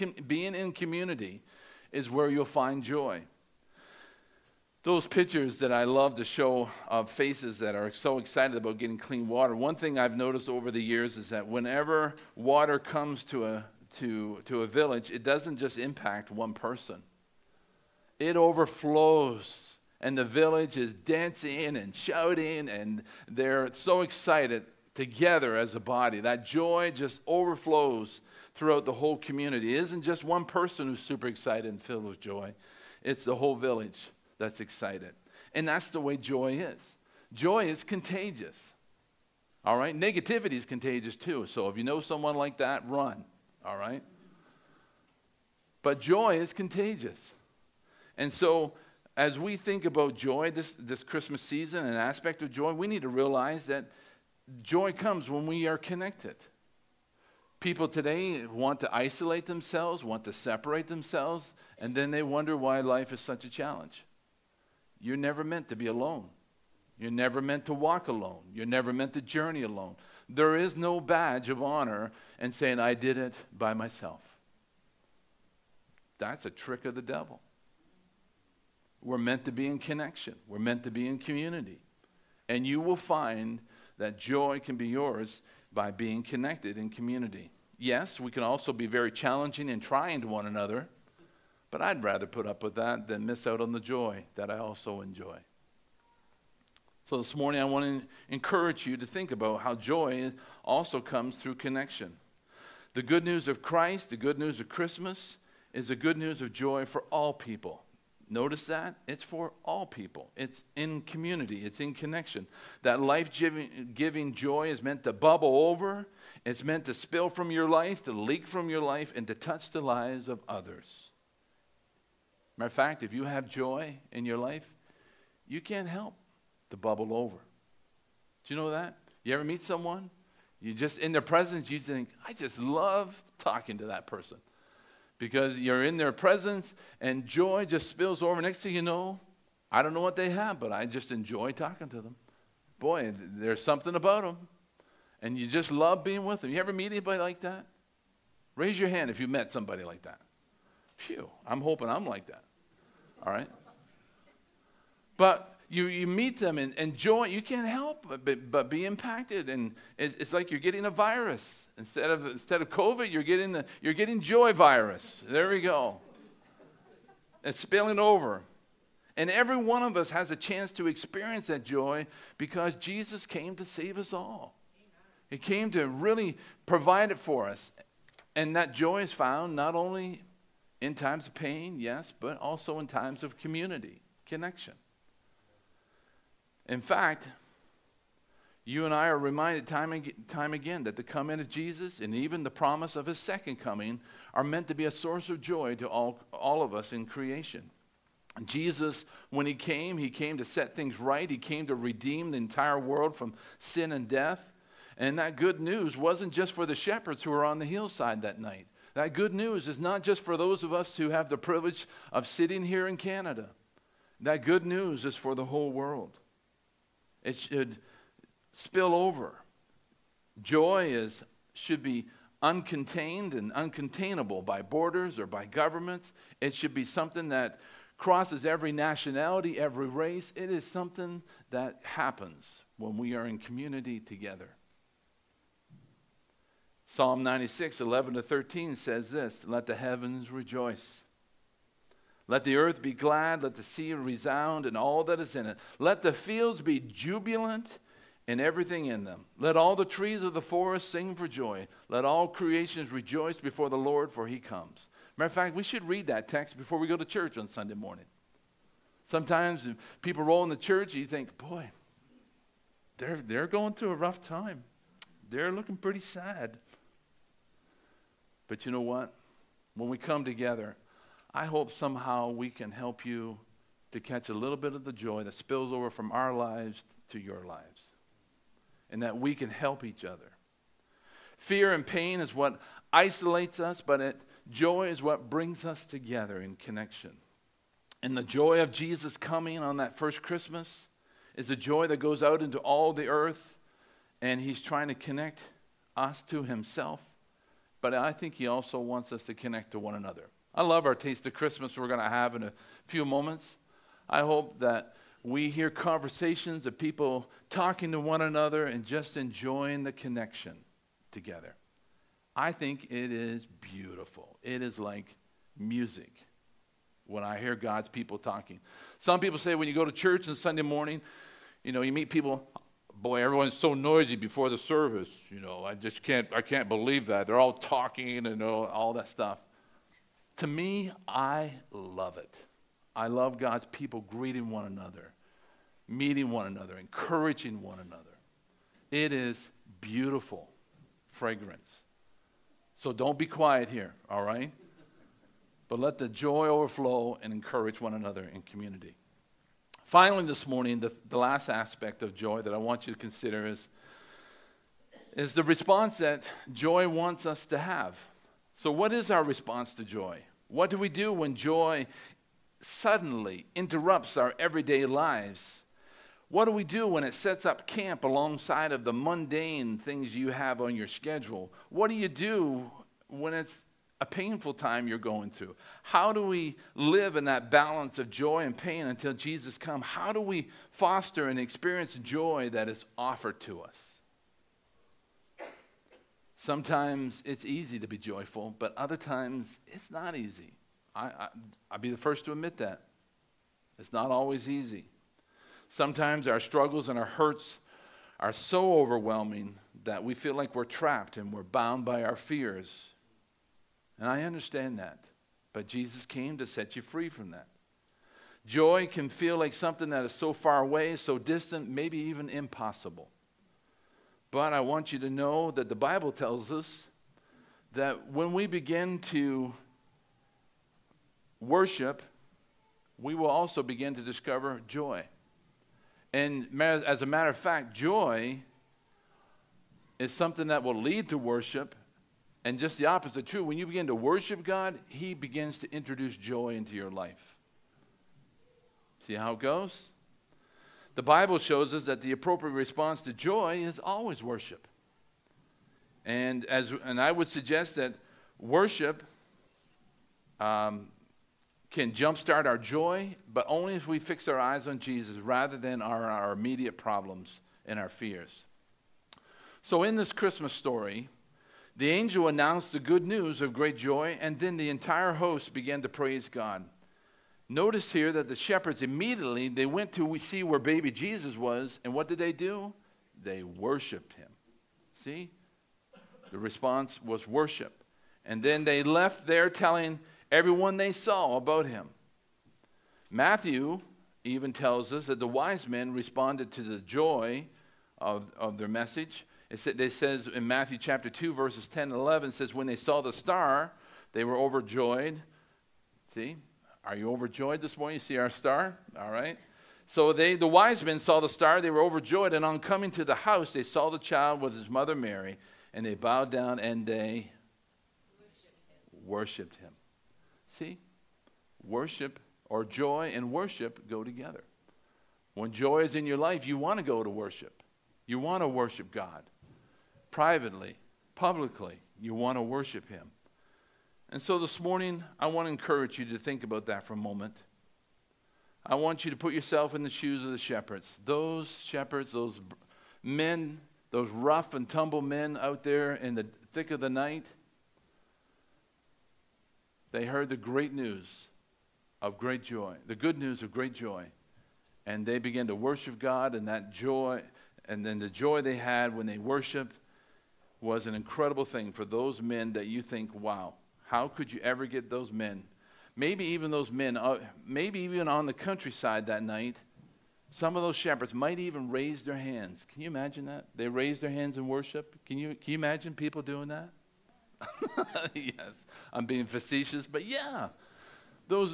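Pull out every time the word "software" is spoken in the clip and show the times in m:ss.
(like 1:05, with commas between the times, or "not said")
not said.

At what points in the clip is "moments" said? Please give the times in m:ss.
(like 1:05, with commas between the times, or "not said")
5:03, 8:46.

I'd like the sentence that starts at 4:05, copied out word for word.
Let the fields be jubilant and everything in them.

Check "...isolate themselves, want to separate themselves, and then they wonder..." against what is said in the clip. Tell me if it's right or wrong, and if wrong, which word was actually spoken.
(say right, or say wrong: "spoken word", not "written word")
right.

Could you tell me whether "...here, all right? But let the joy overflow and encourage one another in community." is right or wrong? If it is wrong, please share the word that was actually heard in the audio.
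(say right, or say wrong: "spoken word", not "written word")
right.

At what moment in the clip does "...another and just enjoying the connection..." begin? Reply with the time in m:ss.
5:08.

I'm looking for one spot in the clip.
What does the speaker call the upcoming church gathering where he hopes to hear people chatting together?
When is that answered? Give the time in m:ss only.
5:00.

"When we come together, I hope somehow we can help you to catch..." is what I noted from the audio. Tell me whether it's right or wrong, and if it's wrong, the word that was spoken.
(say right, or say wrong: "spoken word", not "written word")
right.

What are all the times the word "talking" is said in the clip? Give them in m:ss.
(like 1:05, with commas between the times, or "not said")
2:13, 2:21, 5:07, 5:18, 5:27.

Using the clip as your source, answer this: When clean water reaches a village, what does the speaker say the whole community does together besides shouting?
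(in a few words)
Dancing.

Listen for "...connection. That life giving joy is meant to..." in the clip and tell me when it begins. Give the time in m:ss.
1:51.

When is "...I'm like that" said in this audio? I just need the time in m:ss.
2:31.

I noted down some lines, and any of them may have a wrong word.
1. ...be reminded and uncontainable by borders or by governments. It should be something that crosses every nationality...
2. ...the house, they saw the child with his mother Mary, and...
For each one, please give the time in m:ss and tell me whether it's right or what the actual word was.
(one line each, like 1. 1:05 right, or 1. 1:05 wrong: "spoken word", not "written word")
1. 3:41 wrong: "uncontained", not "reminded"
2. 8:23 right.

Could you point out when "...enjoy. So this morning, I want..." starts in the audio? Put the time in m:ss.
1:35.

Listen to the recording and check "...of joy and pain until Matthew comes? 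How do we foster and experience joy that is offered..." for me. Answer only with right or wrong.
wrong.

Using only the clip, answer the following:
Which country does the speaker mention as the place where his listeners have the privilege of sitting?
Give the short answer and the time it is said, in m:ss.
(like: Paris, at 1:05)
Canada, at 3:32.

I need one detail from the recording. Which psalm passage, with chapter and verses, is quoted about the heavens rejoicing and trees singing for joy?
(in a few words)
Psalm 96:11-13.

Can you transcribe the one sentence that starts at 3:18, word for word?
Jesus, when he came, he came to set things right.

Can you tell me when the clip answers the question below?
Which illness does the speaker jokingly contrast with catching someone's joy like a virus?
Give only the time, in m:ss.
2:42.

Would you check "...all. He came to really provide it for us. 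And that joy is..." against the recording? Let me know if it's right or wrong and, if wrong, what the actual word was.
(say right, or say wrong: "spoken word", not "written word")
right.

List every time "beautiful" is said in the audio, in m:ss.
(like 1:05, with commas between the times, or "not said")
5:13, 5:39.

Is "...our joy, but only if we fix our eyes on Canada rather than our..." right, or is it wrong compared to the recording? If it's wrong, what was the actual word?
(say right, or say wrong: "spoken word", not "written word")
wrong: "Jesus", not "Canada".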